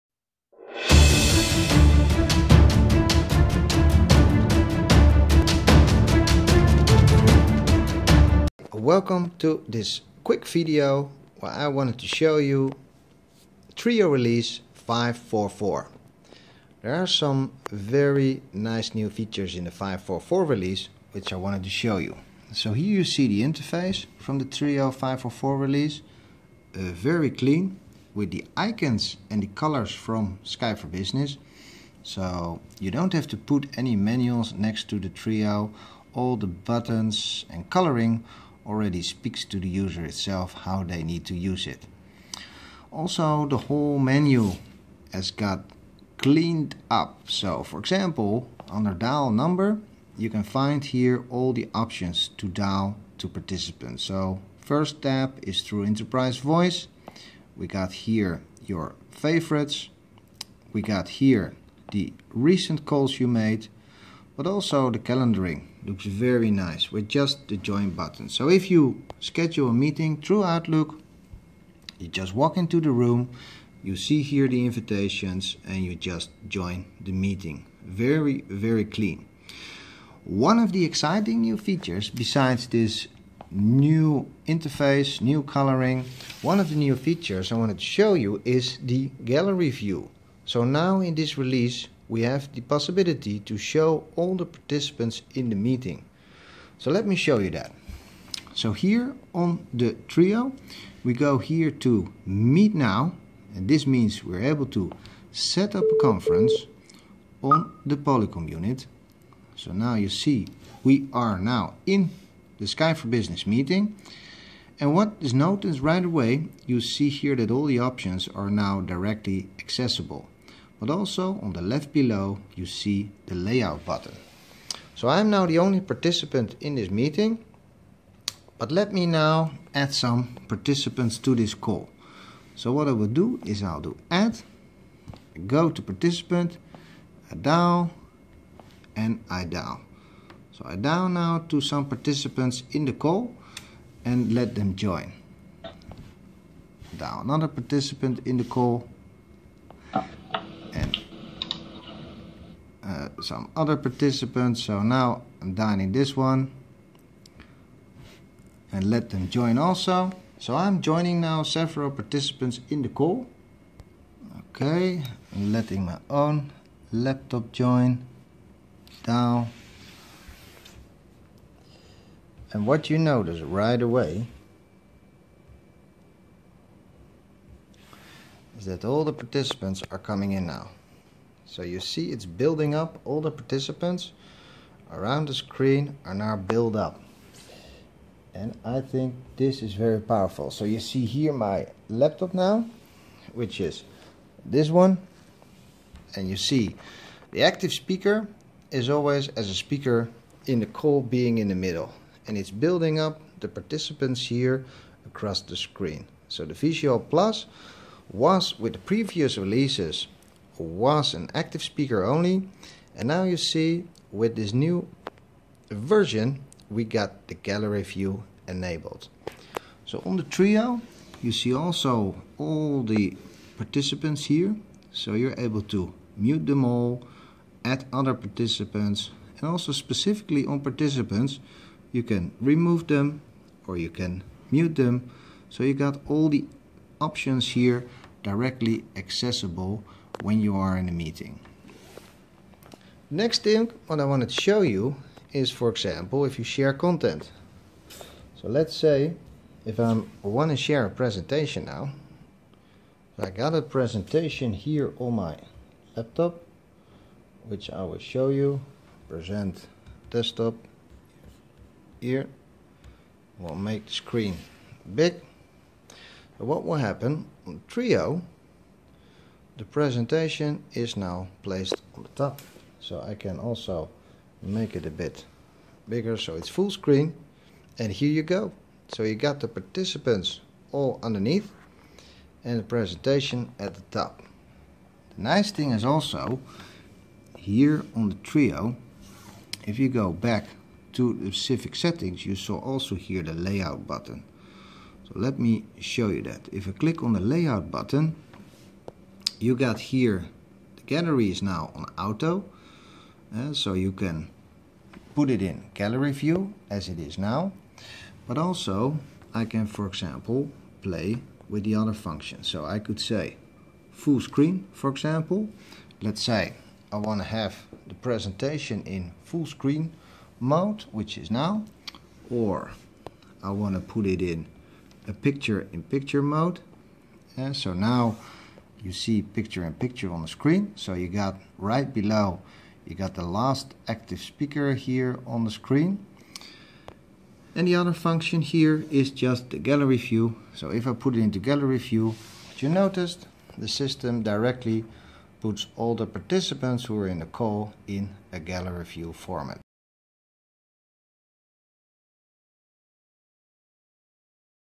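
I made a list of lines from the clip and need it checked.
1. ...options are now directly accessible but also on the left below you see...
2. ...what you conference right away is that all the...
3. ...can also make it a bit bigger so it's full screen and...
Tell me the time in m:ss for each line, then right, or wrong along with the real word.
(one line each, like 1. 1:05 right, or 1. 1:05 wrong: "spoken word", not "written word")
1. 1:57 right
2. 2:52 wrong: "notice", not "conference"
3. 4:33 right.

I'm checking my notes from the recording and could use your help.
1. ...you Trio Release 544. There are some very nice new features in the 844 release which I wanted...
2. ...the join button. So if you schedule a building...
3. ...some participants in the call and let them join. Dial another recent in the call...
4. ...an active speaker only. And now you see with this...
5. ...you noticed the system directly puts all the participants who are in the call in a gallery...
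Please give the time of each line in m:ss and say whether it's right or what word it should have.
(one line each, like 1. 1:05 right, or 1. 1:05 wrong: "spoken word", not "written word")
1. 0:12 wrong: "544", not "844"
2. 1:07 wrong: "meeting", not "building"
3. 2:21 wrong: "participant", not "recent"
4. 3:31 right
5. 5:42 right.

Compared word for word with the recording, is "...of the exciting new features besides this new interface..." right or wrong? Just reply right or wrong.
right.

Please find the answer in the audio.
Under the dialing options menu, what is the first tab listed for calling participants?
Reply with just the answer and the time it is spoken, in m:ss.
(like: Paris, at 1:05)
Enterprise Voice, at 0:55.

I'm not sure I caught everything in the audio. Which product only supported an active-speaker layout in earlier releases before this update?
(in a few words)
Visual Plus.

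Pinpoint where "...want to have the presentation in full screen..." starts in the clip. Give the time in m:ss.
5:16.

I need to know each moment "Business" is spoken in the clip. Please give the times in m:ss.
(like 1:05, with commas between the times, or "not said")
0:30, 1:53.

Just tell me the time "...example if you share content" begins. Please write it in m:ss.
4:05.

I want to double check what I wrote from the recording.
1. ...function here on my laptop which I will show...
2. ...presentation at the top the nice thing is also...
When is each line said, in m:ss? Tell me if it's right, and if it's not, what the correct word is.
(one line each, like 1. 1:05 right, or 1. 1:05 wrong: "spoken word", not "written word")
1. 4:13 wrong: "presentation", not "function"
2. 4:42 right.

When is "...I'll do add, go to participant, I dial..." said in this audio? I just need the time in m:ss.
2:13.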